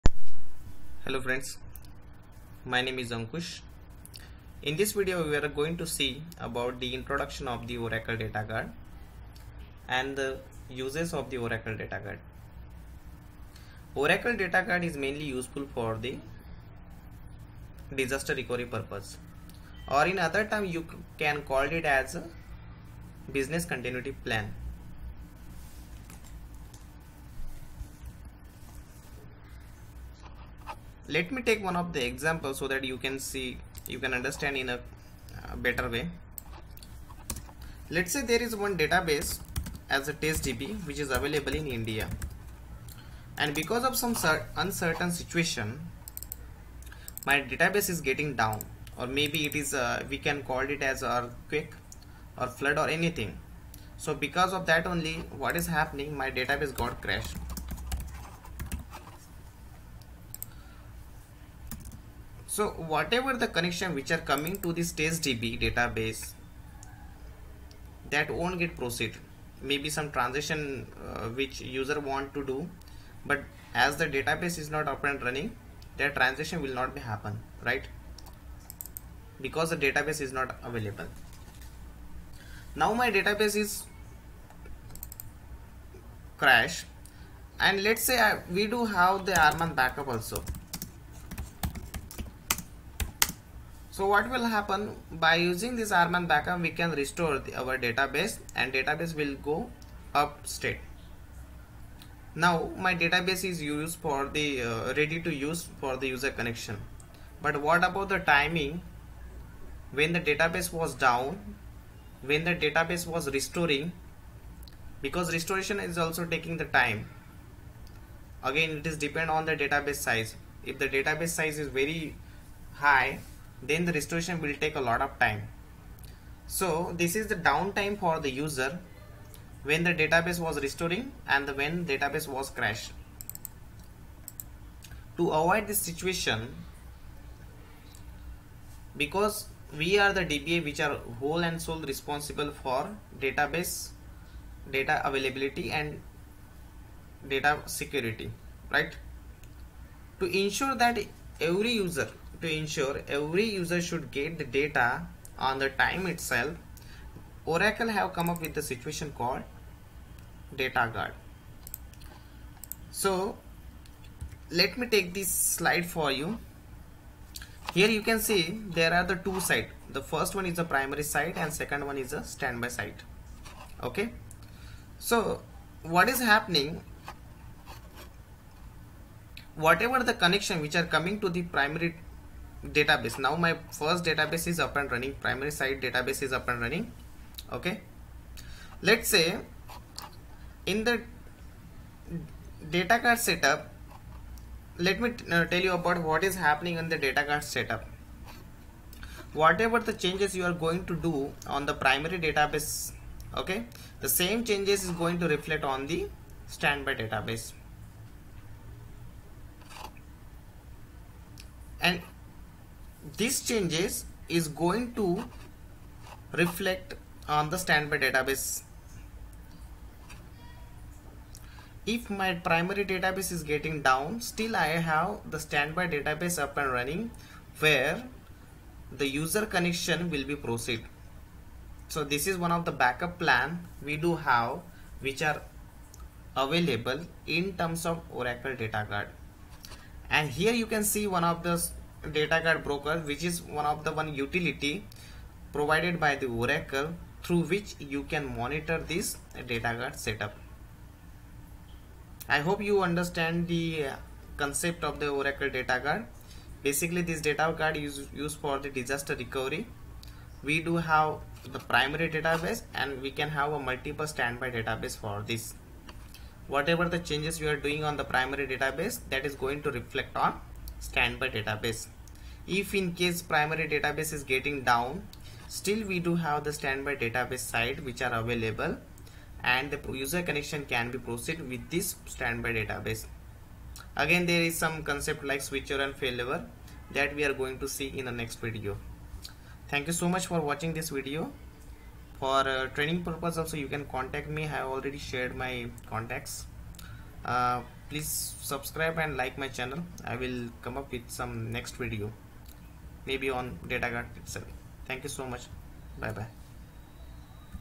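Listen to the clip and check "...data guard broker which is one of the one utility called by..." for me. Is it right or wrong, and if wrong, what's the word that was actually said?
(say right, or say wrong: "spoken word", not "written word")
wrong: "provided", not "called".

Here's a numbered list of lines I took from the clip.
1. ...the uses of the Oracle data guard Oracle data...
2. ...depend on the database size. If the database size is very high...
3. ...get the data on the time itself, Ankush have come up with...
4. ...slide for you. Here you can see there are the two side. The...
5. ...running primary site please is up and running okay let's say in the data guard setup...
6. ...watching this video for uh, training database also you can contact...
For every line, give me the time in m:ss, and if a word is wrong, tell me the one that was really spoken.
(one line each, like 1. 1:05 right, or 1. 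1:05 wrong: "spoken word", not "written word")
1. 0:10 right
2. 1:58 right
3. 2:34 wrong: "Oracle", not "Ankush"
4. 2:45 right
5. 3:04 wrong: "database", not "please"
6. 4:50 wrong: "purpose", not "database".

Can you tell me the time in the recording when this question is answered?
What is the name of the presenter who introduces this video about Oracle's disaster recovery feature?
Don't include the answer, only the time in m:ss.
0:03.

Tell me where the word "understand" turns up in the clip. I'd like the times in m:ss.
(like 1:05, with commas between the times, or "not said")
0:34, 4:12.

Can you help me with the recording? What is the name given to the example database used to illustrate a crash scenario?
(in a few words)
test DB.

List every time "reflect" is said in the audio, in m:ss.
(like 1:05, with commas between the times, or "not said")
3:25, 3:36, 4:29.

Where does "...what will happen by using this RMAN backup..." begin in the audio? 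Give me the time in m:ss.
1:34.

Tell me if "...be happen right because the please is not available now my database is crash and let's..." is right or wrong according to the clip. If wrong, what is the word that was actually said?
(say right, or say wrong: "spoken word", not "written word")
wrong: "database", not "please".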